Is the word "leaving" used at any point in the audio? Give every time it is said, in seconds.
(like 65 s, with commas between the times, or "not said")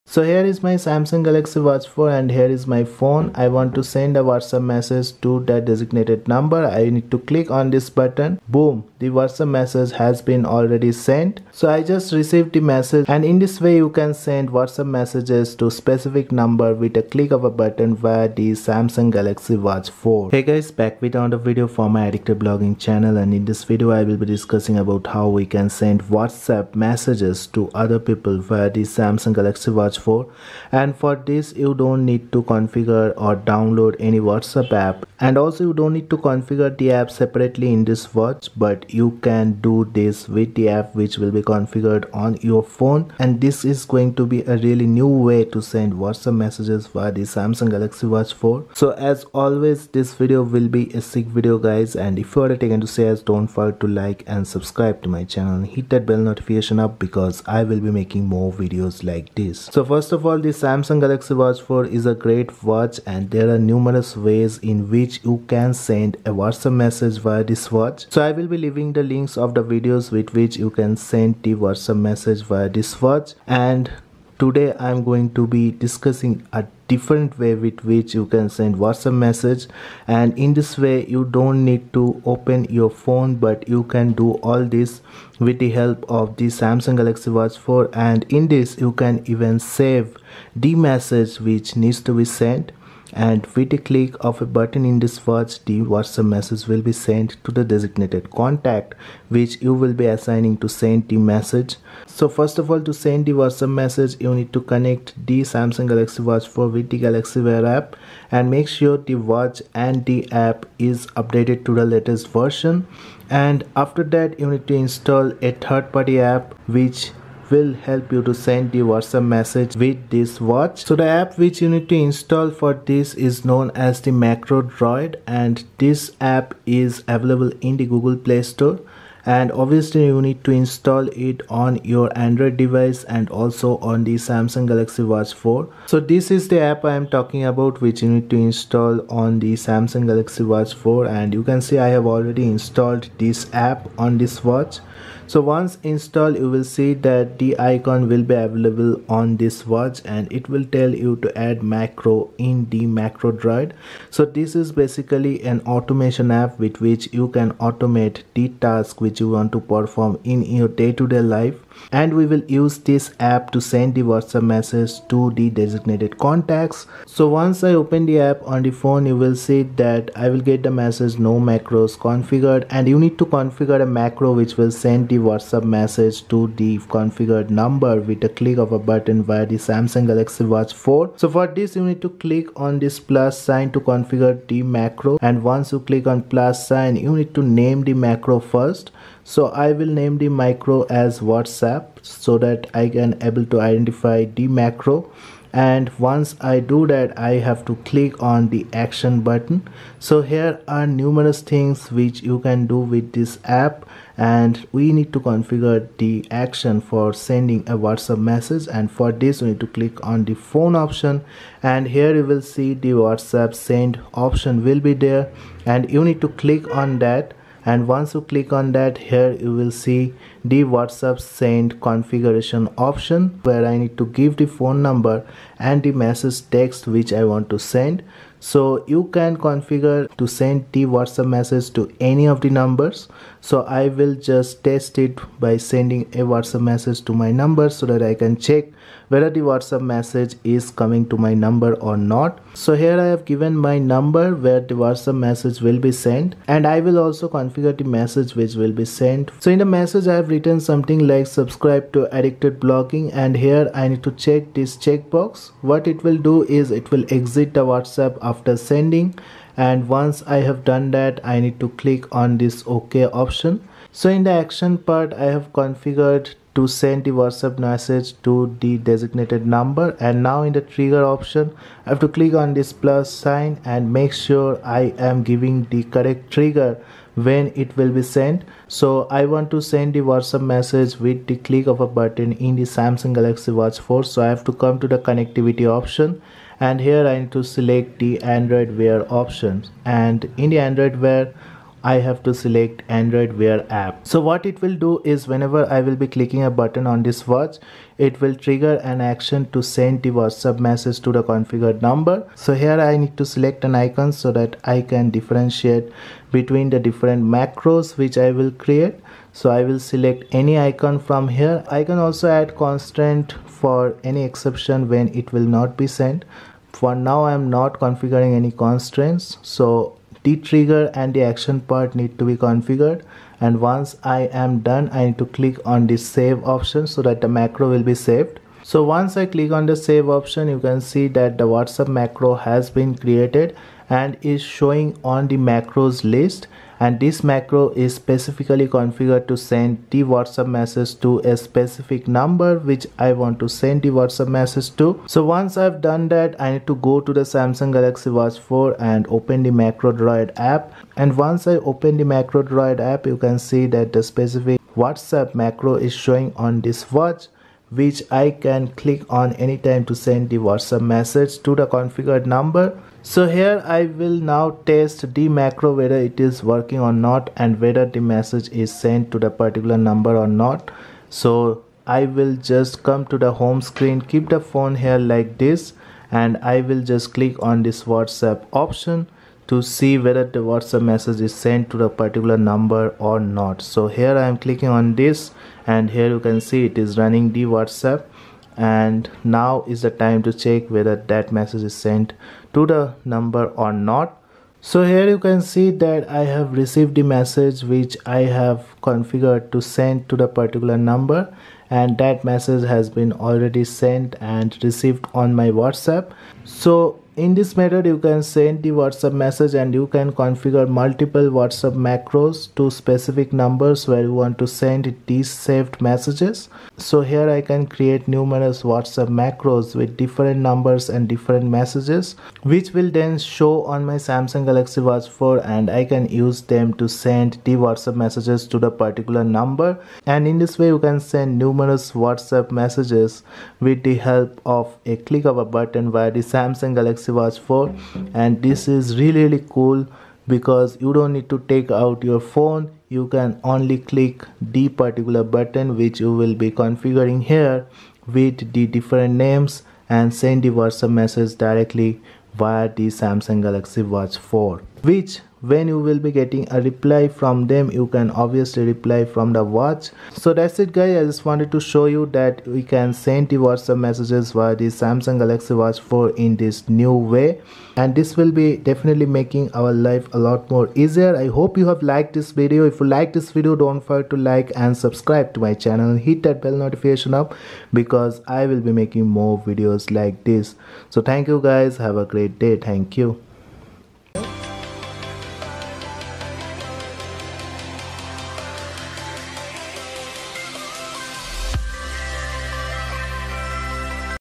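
68 s.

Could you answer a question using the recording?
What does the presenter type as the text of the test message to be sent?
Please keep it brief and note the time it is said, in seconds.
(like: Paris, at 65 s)
Subscribe to Addicted Blogging, at 251 s.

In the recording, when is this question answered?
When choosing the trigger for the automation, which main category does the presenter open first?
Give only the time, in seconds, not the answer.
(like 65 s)
284 s.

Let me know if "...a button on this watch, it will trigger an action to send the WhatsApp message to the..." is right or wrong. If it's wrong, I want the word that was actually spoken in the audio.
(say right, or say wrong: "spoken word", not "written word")
right.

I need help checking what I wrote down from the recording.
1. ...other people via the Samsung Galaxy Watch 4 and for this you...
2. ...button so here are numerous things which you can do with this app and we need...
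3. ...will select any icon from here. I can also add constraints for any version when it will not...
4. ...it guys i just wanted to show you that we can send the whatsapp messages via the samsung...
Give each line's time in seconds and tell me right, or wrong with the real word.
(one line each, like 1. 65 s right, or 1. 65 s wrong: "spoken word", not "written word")
1. 27 s right
2. 199 s right
3. 309 s wrong: "exception", not "version"
4. 460 s right.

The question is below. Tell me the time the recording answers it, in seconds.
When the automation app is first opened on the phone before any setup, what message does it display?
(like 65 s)
171 s.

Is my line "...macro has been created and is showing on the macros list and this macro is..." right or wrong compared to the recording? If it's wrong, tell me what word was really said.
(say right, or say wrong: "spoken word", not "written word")
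right.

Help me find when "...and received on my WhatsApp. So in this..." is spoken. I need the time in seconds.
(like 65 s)
404 s.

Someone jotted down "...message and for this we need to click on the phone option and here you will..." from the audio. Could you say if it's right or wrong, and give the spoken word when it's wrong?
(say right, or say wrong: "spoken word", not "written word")
right.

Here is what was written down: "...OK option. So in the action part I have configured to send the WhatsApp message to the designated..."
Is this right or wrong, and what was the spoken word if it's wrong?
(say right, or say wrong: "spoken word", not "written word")
right.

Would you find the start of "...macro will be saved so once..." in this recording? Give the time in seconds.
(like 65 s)
327 s.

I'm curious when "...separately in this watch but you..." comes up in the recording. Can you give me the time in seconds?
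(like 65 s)
37 s.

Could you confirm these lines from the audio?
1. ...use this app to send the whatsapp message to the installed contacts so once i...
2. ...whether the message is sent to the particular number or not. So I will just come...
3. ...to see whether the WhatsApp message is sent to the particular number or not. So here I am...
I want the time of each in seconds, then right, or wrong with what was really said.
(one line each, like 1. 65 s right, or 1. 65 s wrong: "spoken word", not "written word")
1. 162 s wrong: "designated", not "installed"
2. 367 s right
3. 379 s right.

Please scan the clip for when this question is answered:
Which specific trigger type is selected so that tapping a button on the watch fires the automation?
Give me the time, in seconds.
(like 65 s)
292 s.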